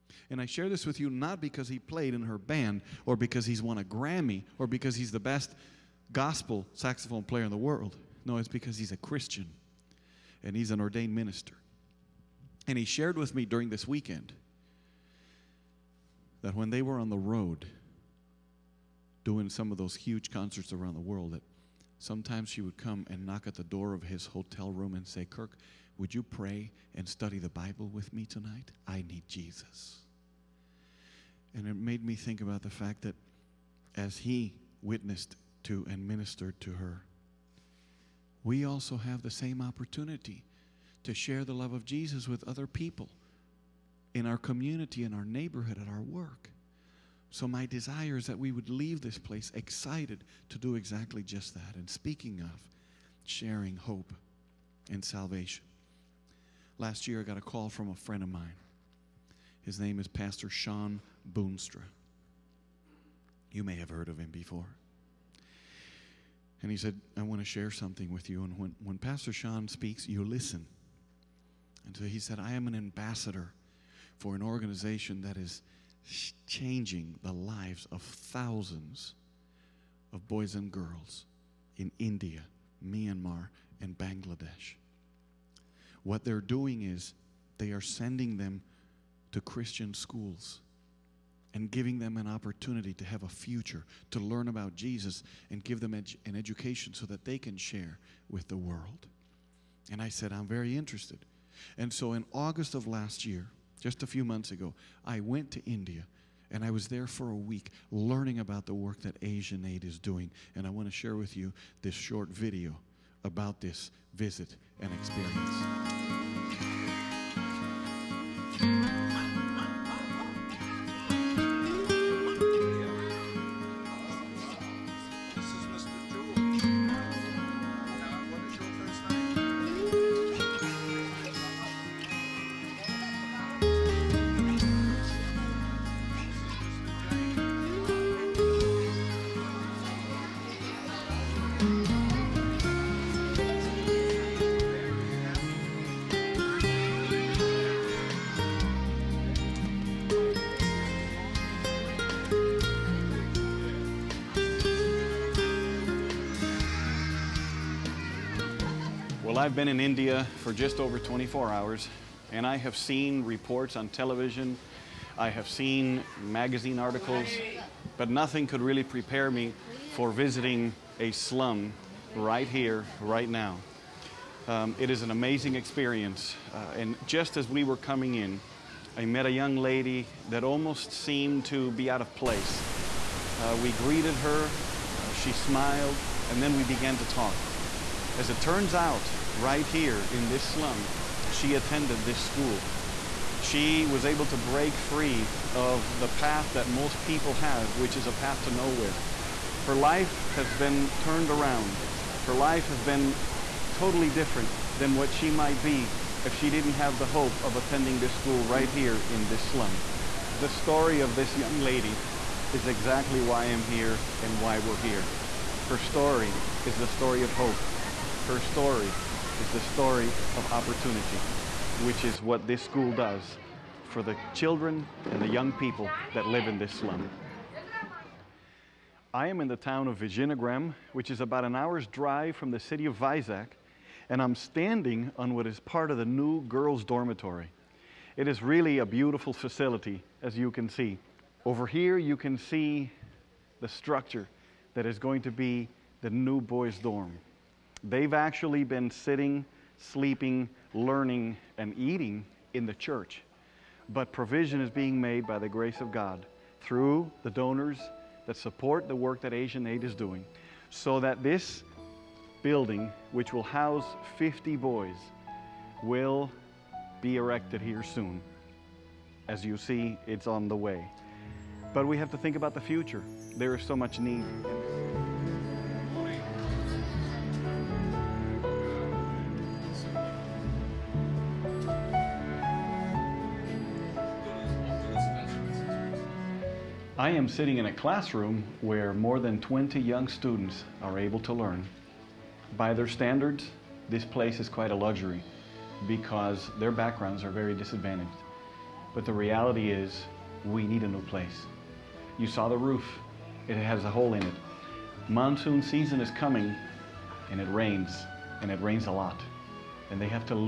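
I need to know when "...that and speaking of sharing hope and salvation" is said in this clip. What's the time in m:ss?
0:51.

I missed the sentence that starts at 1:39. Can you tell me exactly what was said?
And I said, I'm very interested.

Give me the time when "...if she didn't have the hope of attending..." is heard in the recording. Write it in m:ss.
3:26.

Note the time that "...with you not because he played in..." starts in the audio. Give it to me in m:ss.
0:00.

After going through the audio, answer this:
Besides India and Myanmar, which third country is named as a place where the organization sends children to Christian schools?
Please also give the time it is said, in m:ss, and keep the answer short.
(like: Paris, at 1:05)
Bangladesh, at 1:23.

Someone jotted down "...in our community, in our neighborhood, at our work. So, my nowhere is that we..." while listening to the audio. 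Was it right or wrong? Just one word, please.
wrong.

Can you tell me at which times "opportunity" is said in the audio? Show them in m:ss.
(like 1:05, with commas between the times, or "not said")
0:39, 1:32, 3:40.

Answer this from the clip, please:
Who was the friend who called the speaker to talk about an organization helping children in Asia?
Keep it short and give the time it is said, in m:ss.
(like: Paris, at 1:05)
Shawn Boonstra, at 1:00.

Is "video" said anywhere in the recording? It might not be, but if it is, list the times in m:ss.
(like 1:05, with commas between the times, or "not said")
1:52.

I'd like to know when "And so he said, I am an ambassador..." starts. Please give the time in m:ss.
1:11.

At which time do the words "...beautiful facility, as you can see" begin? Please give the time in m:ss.
3:58.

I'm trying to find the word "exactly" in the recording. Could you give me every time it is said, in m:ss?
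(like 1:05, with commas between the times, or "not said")
0:50, 3:32.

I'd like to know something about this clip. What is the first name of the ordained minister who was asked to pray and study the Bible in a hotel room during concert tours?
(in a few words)
Kirk.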